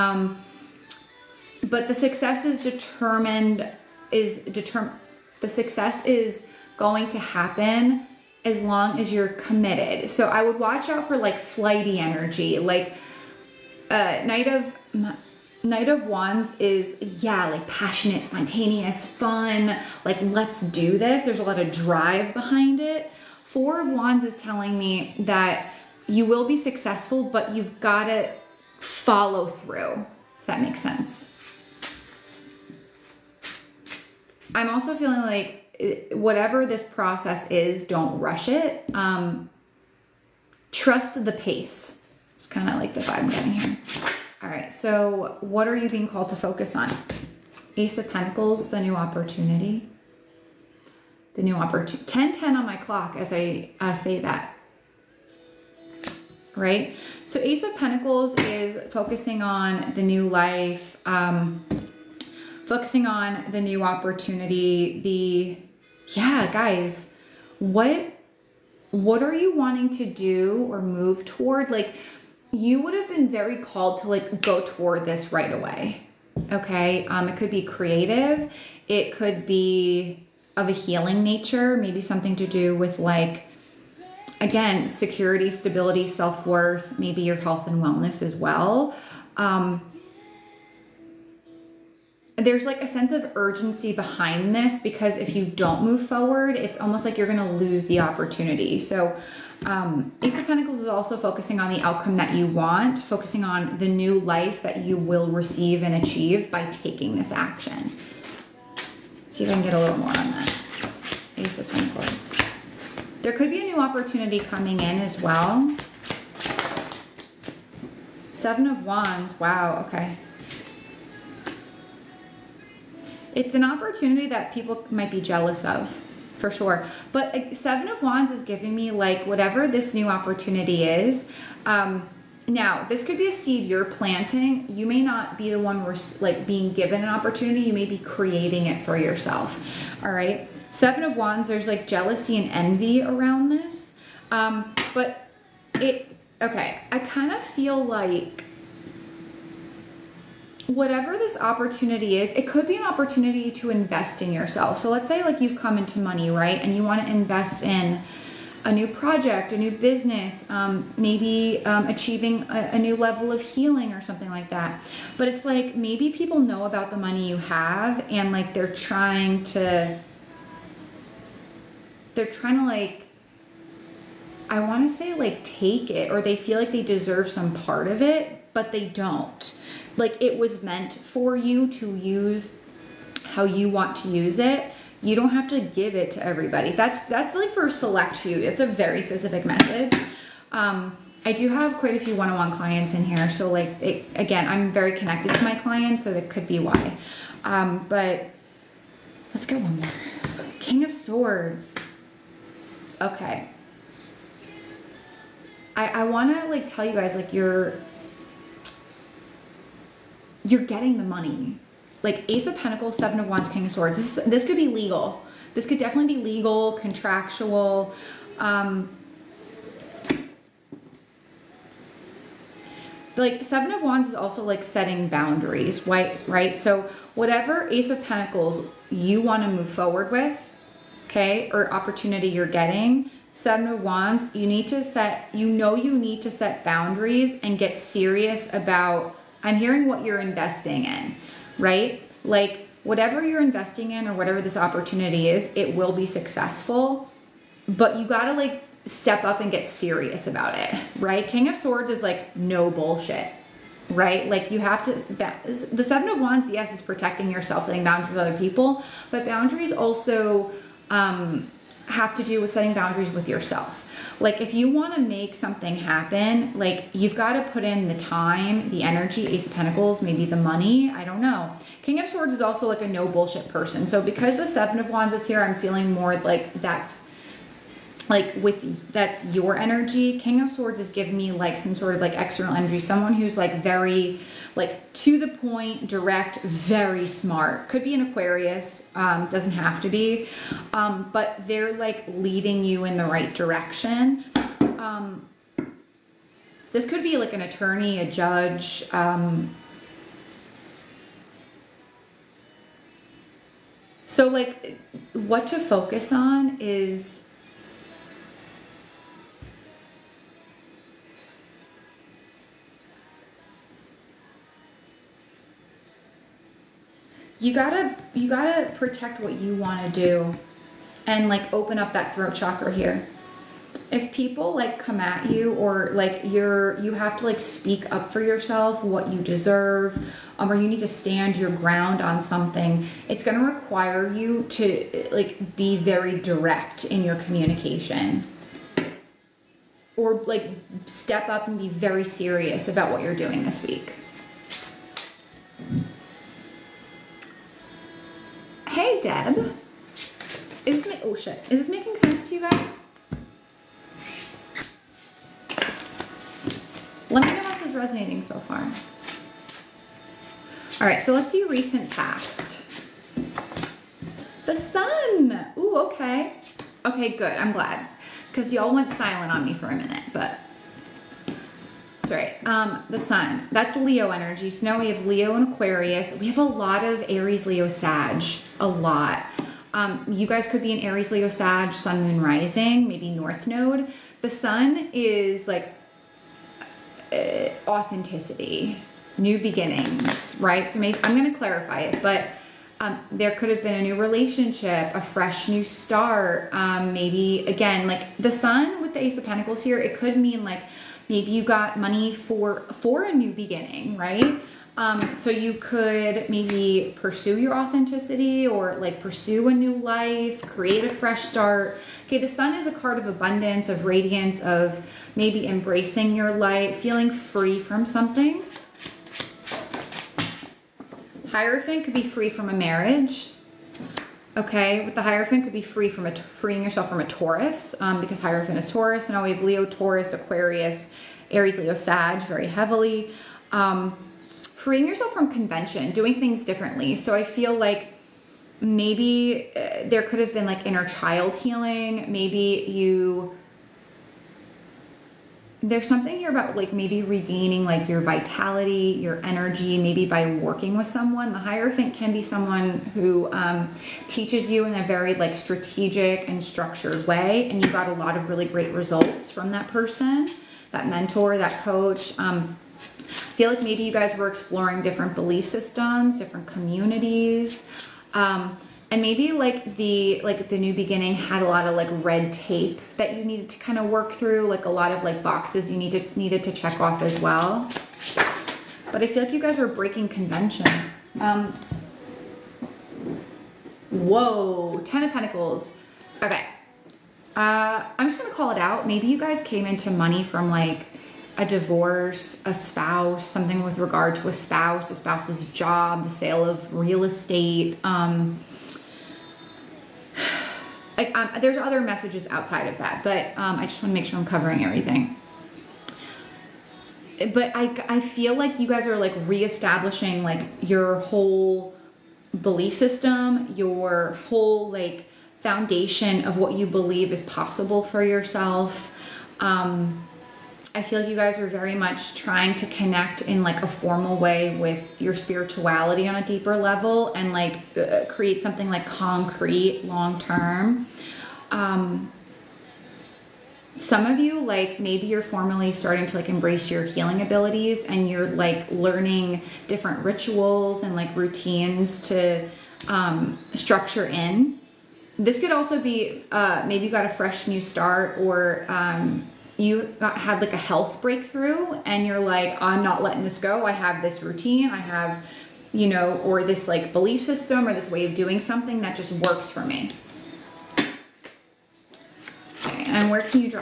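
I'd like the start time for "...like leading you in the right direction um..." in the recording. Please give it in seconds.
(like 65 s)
291 s.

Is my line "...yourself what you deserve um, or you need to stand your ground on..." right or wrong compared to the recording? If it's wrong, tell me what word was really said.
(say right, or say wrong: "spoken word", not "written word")
right.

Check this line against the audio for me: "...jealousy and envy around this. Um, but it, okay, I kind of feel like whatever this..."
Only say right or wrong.
right.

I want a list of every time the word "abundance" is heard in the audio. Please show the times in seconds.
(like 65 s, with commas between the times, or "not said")
413 s.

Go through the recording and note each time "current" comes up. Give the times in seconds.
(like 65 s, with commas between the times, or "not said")
not said.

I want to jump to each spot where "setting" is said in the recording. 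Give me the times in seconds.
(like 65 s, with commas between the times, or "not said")
224 s, 257 s, 262 s.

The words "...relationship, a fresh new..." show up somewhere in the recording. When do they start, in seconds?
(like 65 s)
393 s.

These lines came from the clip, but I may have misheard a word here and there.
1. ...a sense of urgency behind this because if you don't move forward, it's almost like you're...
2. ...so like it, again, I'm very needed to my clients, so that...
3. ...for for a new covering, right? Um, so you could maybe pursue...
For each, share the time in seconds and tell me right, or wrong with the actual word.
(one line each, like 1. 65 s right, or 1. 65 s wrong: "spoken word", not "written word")
1. 92 s right
2. 193 s wrong: "connected", not "needed"
3. 402 s wrong: "beginning", not "covering".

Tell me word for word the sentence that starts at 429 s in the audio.
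And now we have Leo, Taurus, Aquarius, Aries, Leo, Sag very heavily.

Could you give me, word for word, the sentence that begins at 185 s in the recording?
You don't have to give it to everybody.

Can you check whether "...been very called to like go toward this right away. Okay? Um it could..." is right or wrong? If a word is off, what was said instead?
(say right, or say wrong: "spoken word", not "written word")
right.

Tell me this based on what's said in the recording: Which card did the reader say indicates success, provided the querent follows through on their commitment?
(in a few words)
Four of Wands.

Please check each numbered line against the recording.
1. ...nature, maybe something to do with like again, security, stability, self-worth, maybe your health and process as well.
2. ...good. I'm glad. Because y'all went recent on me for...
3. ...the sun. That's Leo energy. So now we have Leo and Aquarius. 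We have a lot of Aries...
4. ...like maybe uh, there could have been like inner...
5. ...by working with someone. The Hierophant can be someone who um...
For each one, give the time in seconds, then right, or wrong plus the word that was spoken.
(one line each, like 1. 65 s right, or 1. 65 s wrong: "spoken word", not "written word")
1. 81 s wrong: "wellness", not "process"
2. 367 s wrong: "silent", not "recent"
3. 372 s right
4. 437 s right
5. 450 s right.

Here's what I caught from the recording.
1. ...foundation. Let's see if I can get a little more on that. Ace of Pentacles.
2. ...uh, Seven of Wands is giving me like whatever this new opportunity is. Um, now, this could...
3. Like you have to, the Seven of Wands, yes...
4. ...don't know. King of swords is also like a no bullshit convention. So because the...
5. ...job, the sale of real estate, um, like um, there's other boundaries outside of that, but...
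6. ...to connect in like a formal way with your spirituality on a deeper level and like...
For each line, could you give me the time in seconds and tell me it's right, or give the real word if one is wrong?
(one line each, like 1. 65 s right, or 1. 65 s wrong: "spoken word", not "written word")
1. 107 s wrong: "action", not "foundation"
2. 127 s right
3. 254 s right
4. 271 s wrong: "person", not "convention"
5. 495 s wrong: "messages", not "boundaries"
6. 522 s right.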